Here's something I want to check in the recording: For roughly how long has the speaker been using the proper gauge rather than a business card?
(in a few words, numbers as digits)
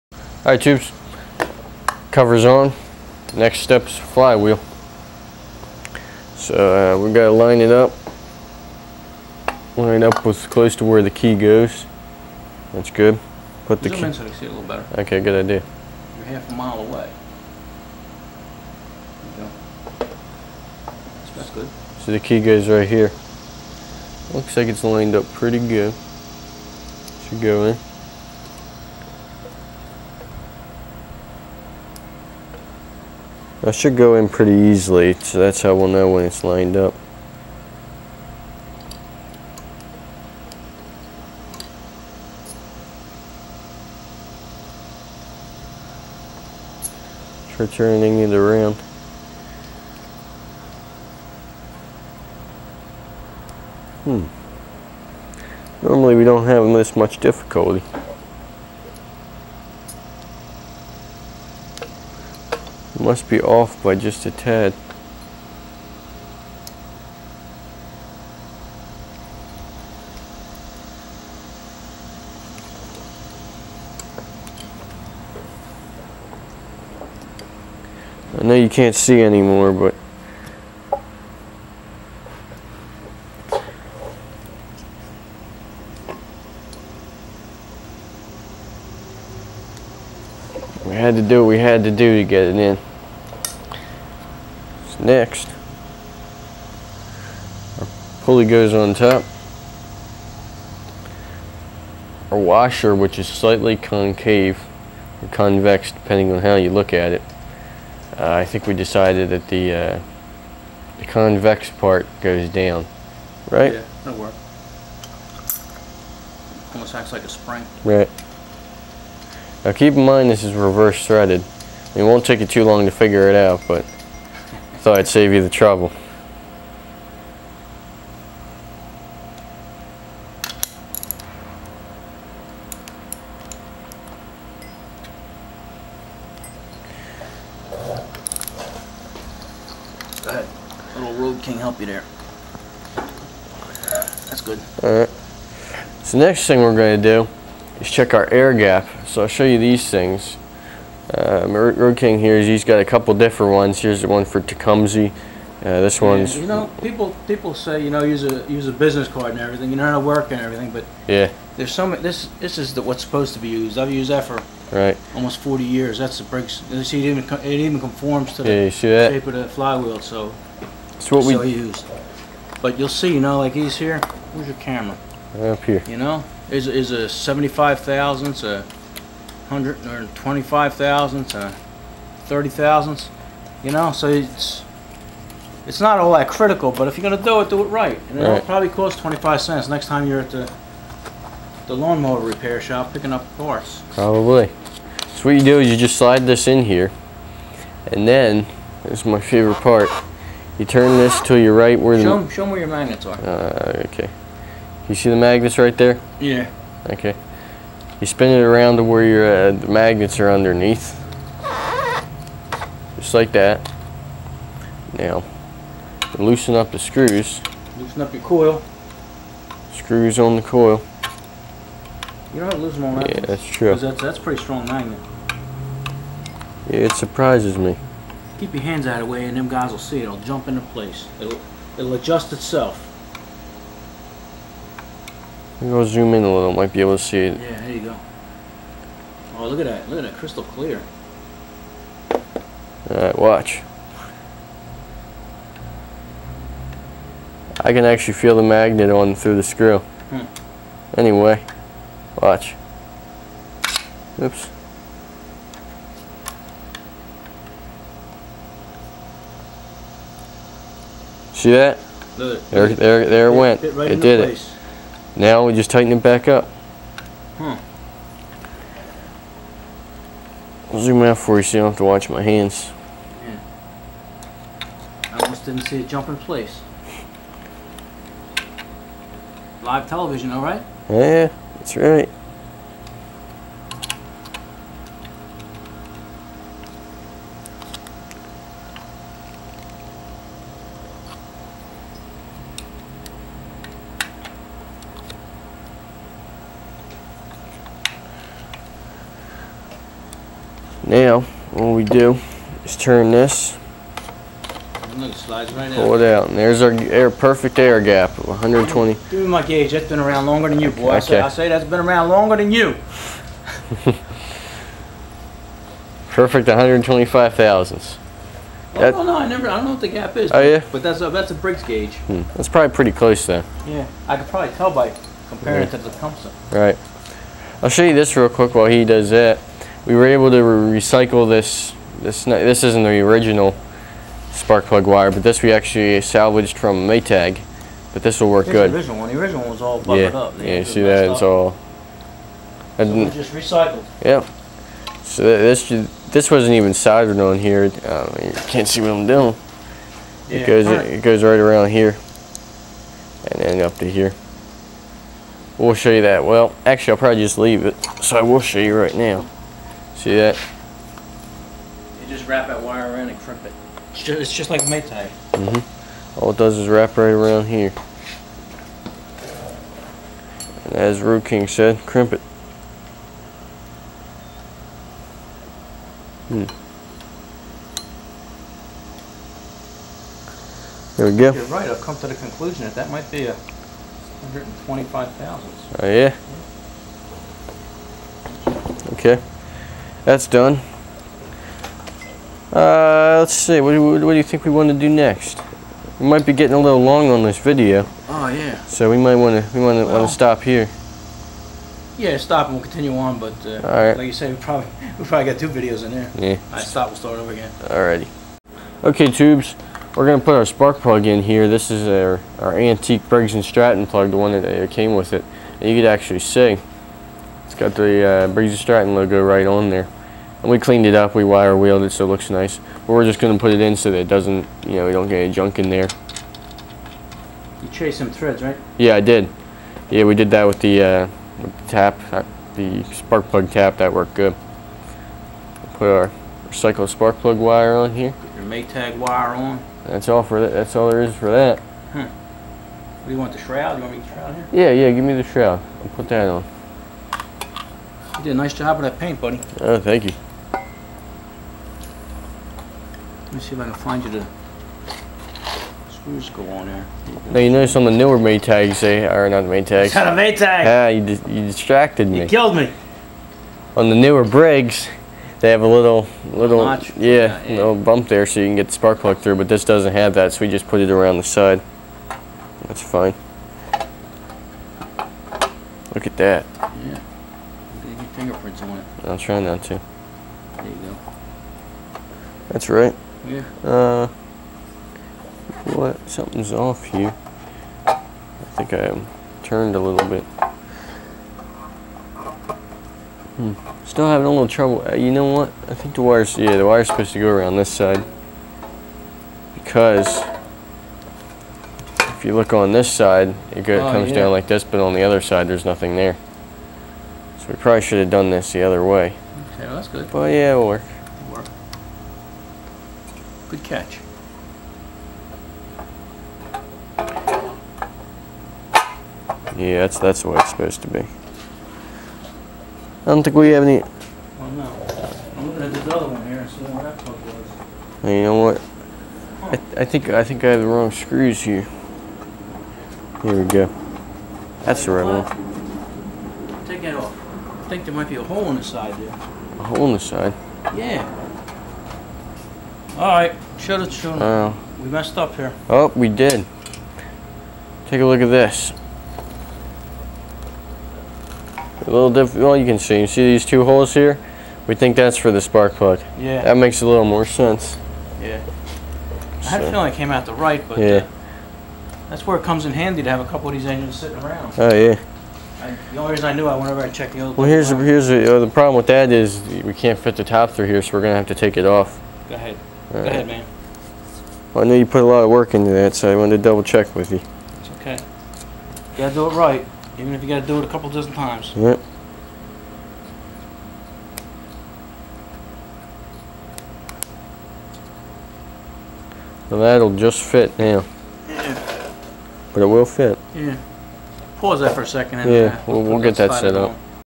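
almost 40 years.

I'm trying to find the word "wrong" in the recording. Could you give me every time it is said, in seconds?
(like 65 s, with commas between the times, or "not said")
530 s.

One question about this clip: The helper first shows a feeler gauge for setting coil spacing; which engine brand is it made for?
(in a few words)
Tecumseh.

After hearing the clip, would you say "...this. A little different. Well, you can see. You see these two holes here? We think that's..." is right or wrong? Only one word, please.
right.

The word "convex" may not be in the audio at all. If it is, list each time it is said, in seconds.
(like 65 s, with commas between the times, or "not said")
105 s, 111 s.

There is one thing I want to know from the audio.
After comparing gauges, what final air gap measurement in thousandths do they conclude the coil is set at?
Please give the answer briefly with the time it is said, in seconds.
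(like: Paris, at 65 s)
125, at 383 s.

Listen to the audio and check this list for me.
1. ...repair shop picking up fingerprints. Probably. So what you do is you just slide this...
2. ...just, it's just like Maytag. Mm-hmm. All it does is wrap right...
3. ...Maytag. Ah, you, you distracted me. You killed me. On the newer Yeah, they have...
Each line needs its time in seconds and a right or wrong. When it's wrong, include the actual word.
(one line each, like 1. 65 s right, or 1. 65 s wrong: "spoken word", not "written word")
1. 192 s wrong: "parts", not "fingerprints"
2. 364 s right
3. 460 s wrong: "Briggs", not "Yeah".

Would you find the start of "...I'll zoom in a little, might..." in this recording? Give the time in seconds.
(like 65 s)
235 s.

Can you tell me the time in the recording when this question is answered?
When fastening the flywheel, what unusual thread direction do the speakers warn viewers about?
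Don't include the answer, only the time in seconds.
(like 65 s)
120 s.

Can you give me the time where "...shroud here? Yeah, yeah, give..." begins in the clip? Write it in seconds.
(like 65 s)
444 s.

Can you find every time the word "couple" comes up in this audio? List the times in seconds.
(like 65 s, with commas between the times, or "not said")
152 s, 563 s, 580 s.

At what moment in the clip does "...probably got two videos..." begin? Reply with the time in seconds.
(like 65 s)
405 s.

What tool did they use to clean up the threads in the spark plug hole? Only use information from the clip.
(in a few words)
spark plug tap.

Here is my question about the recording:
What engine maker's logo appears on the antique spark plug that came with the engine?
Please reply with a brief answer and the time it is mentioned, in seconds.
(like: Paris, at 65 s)
Briggs and Stratton, at 418 s.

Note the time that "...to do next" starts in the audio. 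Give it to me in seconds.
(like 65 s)
394 s.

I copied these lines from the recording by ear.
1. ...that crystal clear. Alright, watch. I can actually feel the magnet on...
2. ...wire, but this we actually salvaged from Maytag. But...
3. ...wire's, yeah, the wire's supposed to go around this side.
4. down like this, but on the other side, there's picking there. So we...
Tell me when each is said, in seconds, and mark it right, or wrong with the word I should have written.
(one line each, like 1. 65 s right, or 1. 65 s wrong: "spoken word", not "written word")
1. 240 s right
2. 334 s right
3. 496 s right
4. 504 s wrong: "nothing", not "picking".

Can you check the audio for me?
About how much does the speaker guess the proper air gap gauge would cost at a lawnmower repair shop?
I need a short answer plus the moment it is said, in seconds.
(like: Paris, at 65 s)
25 cents, at 188 s.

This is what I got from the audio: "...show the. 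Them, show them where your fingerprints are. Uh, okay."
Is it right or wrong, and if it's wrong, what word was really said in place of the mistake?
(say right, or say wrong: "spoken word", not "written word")
wrong: "magnets", not "fingerprints".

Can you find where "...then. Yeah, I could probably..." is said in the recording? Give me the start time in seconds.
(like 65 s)
323 s.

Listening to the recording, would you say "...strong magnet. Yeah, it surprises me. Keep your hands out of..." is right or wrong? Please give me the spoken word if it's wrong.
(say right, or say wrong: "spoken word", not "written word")
right.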